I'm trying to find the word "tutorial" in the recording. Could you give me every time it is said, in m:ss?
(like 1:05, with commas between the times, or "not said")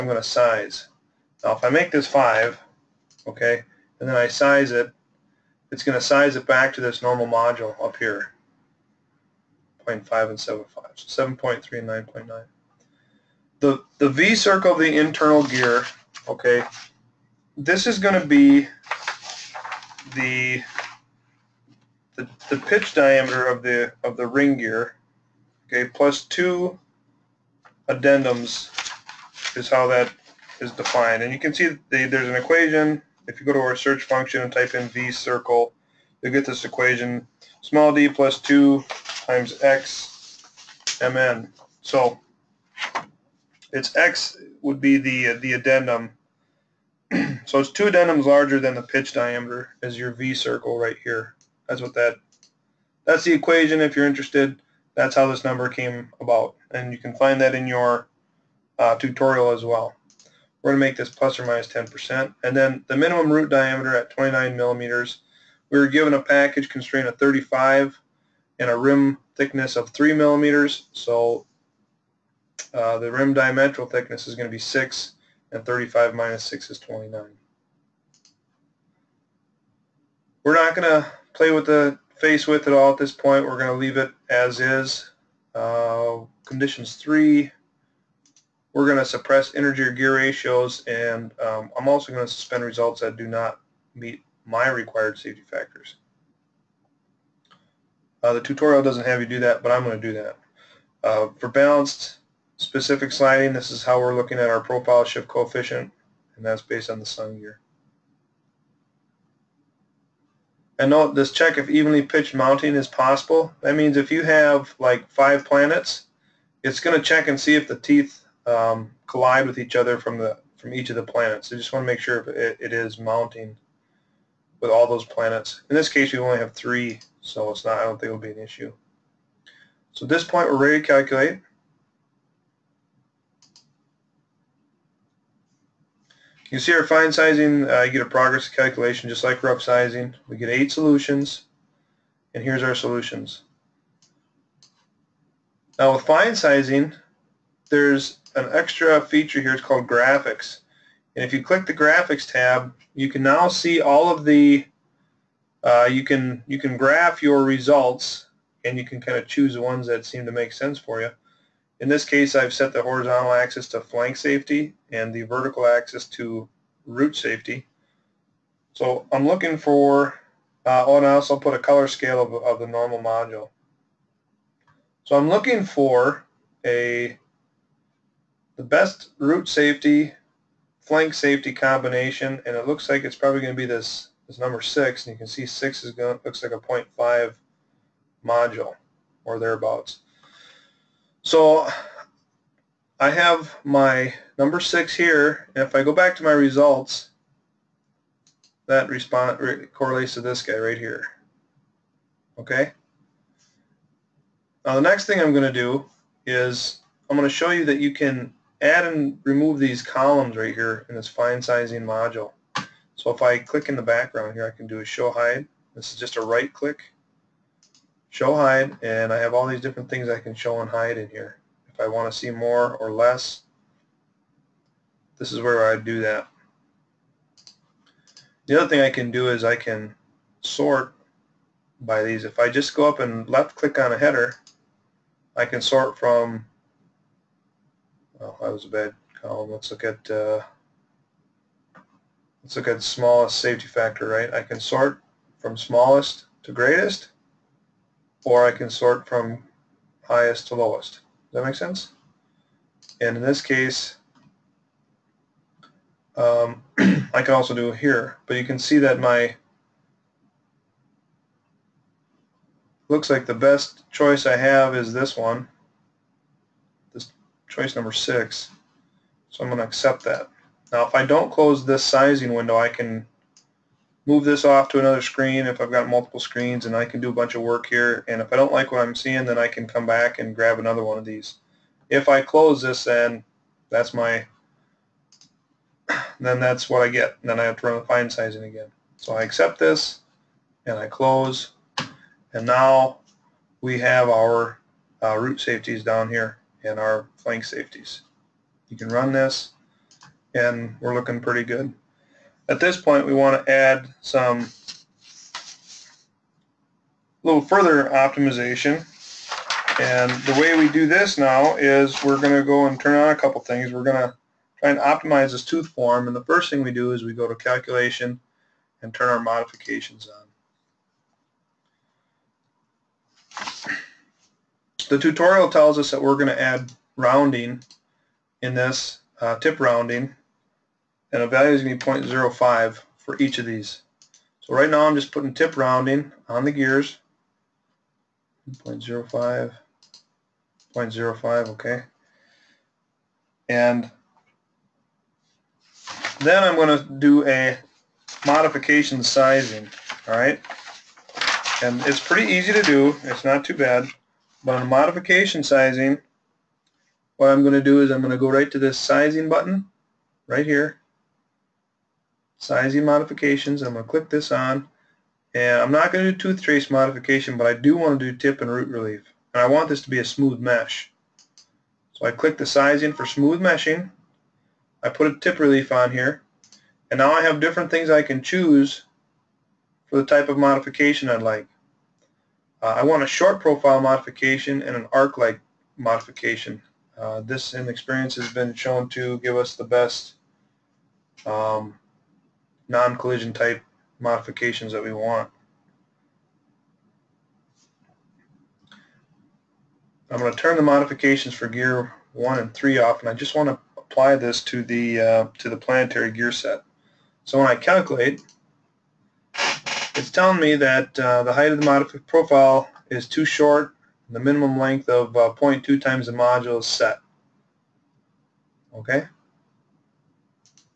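0:58, 1:38, 5:24.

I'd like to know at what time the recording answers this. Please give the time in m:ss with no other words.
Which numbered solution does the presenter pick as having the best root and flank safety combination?
3:04.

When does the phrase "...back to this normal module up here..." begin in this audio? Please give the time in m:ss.
0:06.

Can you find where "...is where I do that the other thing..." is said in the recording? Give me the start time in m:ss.
3:45.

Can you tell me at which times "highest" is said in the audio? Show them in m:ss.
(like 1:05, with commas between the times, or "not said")
4:10.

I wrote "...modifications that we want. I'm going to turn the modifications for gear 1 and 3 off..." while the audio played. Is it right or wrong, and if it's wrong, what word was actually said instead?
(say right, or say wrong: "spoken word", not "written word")
right.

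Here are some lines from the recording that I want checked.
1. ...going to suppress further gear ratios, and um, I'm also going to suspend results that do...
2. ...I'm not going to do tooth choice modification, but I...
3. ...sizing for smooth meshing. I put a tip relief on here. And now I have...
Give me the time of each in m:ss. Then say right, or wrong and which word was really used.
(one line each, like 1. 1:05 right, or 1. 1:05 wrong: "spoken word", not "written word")
1. 1:28 wrong: "integer", not "further"
2. 6:05 wrong: "trace", not "choice"
3. 6:12 right.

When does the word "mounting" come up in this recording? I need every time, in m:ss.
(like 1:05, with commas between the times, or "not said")
1:52, 2:02.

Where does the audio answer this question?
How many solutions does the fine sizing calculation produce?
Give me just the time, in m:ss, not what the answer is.
2:20.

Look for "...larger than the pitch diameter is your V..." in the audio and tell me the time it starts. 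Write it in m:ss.
0:48.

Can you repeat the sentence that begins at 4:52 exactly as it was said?
And now we have our uh, root safeties down here and our flank safeties.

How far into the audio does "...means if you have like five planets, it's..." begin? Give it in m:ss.
1:53.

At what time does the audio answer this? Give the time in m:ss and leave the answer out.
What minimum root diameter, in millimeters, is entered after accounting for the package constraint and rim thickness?
1:04.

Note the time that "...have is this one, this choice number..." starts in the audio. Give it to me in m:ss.
4:24.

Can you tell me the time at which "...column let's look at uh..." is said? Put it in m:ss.
3:59.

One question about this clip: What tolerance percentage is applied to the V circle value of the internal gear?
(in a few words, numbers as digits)
10%.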